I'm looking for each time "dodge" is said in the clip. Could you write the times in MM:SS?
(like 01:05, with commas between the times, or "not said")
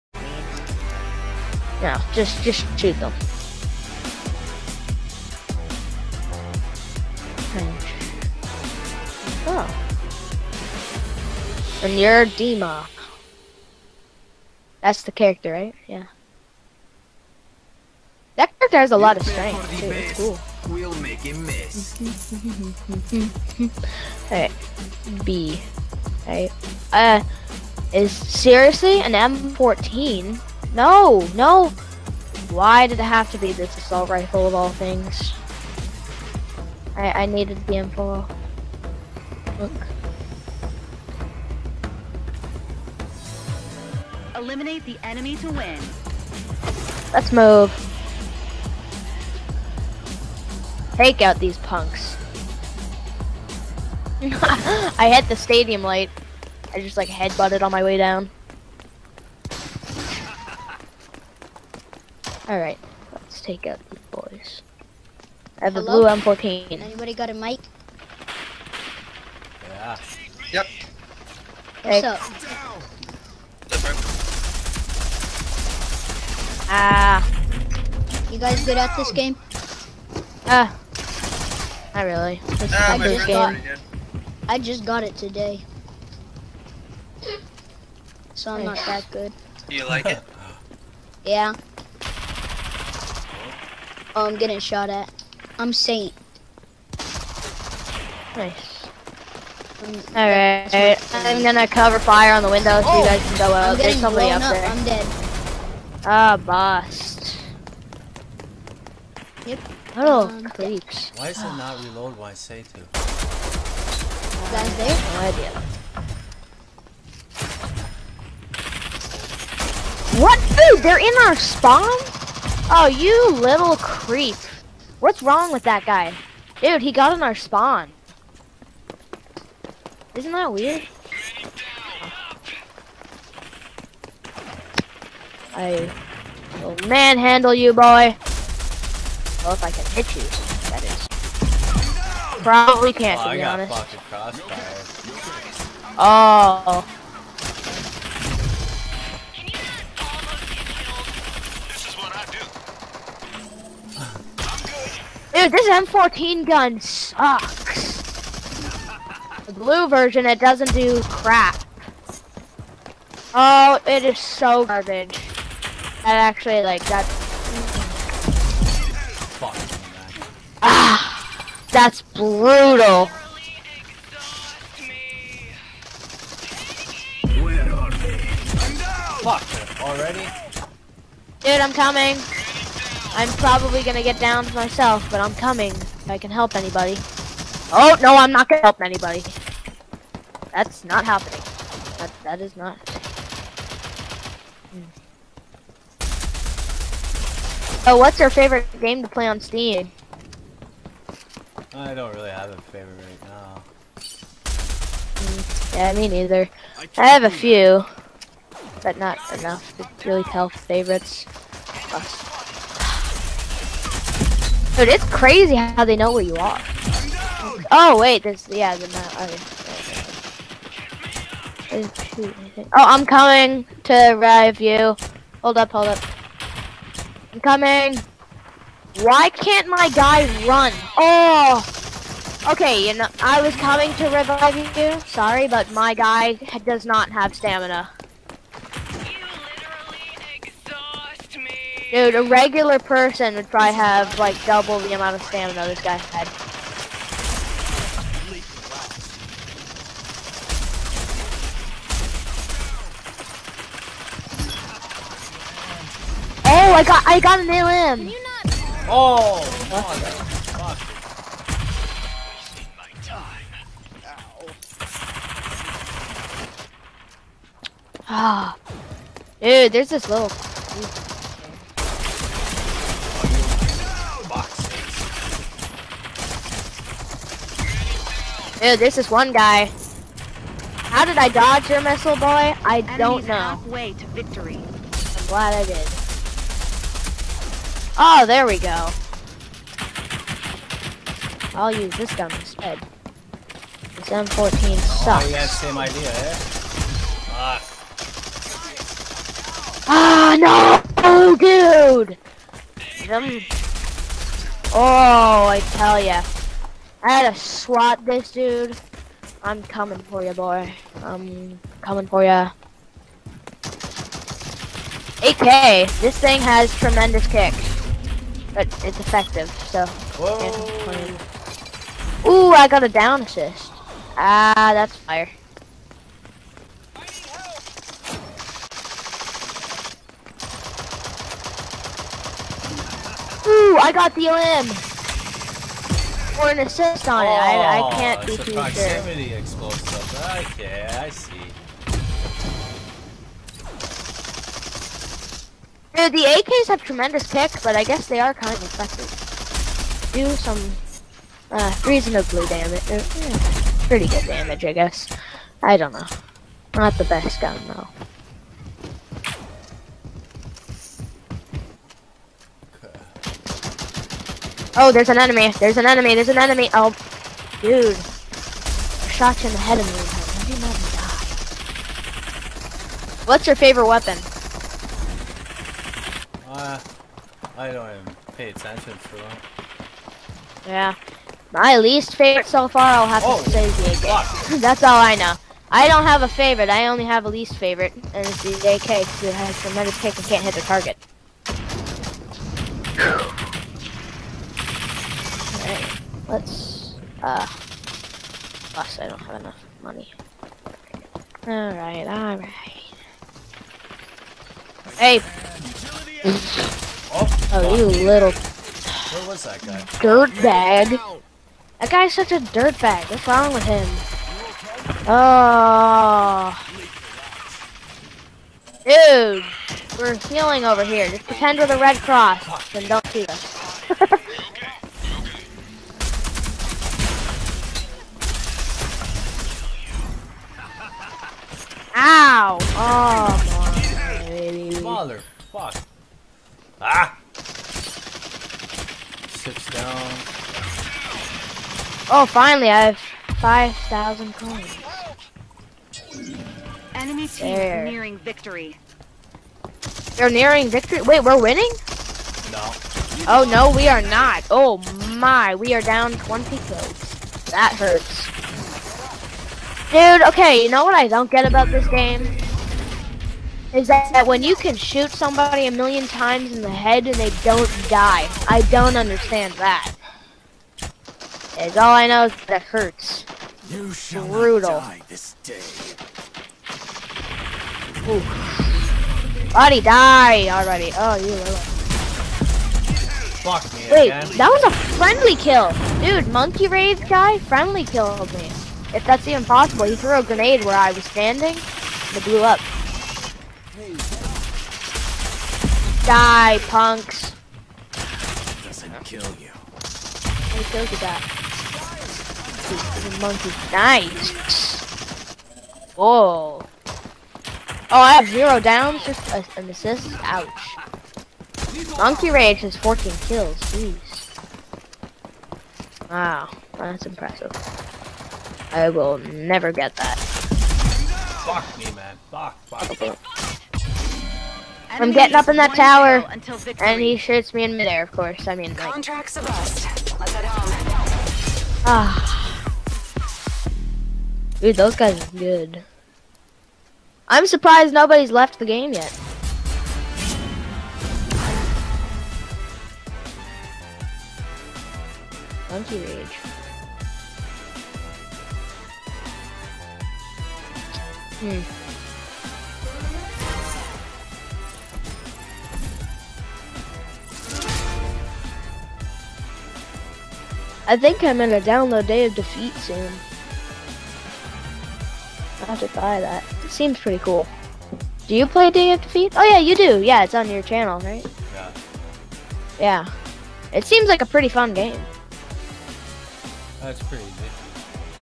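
04:41.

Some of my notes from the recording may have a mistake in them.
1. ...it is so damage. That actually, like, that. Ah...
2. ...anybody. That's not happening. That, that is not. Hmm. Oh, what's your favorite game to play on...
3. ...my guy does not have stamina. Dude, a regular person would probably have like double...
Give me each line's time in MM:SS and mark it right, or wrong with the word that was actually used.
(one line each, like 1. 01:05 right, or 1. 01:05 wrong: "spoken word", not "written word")
1. 02:43 wrong: "garbage", not "damage"
2. 03:08 right
3. 03:55 right.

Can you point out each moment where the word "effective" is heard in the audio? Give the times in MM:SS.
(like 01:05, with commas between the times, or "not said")
05:18, 05:48.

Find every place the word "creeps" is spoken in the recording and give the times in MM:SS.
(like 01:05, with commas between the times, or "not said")
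01:50, 02:03.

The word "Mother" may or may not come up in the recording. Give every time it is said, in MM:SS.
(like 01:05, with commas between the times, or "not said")
07:14.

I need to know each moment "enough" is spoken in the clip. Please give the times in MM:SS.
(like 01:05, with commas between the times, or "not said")
03:29, 06:39.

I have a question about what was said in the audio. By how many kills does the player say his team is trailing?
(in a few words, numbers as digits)
20.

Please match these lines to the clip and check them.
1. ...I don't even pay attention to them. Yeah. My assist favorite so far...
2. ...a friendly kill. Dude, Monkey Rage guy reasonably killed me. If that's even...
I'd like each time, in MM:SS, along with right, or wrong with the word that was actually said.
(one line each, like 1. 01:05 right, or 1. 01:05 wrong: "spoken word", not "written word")
1. 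06:17 wrong: "least", not "assist"
2. 08:04 wrong: "friendly", not "reasonably".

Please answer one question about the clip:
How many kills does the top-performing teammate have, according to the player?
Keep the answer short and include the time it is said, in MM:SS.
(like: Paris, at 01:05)
14, at 08:32.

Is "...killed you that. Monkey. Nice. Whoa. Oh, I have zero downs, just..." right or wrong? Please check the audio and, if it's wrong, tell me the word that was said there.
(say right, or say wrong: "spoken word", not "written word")
right.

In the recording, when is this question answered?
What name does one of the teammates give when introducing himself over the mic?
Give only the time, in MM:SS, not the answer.
01:35.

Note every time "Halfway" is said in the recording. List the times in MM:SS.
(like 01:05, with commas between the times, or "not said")
04:43.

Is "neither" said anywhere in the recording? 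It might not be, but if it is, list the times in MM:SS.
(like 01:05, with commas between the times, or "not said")
03:26.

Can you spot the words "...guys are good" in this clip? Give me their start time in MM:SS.
08:54.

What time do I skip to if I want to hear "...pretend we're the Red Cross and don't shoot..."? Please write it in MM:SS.
07:01.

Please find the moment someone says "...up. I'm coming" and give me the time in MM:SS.
03:45.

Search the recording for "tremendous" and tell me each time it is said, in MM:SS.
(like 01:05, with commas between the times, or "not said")
05:16, 05:46, 06:29.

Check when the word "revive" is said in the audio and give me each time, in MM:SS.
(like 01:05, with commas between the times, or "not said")
03:44, 03:54.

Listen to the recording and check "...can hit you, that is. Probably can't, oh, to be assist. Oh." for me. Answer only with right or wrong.
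wrong.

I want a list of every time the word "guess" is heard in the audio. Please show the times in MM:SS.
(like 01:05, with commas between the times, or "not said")
05:47, 05:54.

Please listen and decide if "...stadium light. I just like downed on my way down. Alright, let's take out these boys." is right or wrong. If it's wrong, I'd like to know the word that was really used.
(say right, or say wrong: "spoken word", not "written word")
wrong: "headbutted", not "downed".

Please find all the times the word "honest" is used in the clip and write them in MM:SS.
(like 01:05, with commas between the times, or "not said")
02:23.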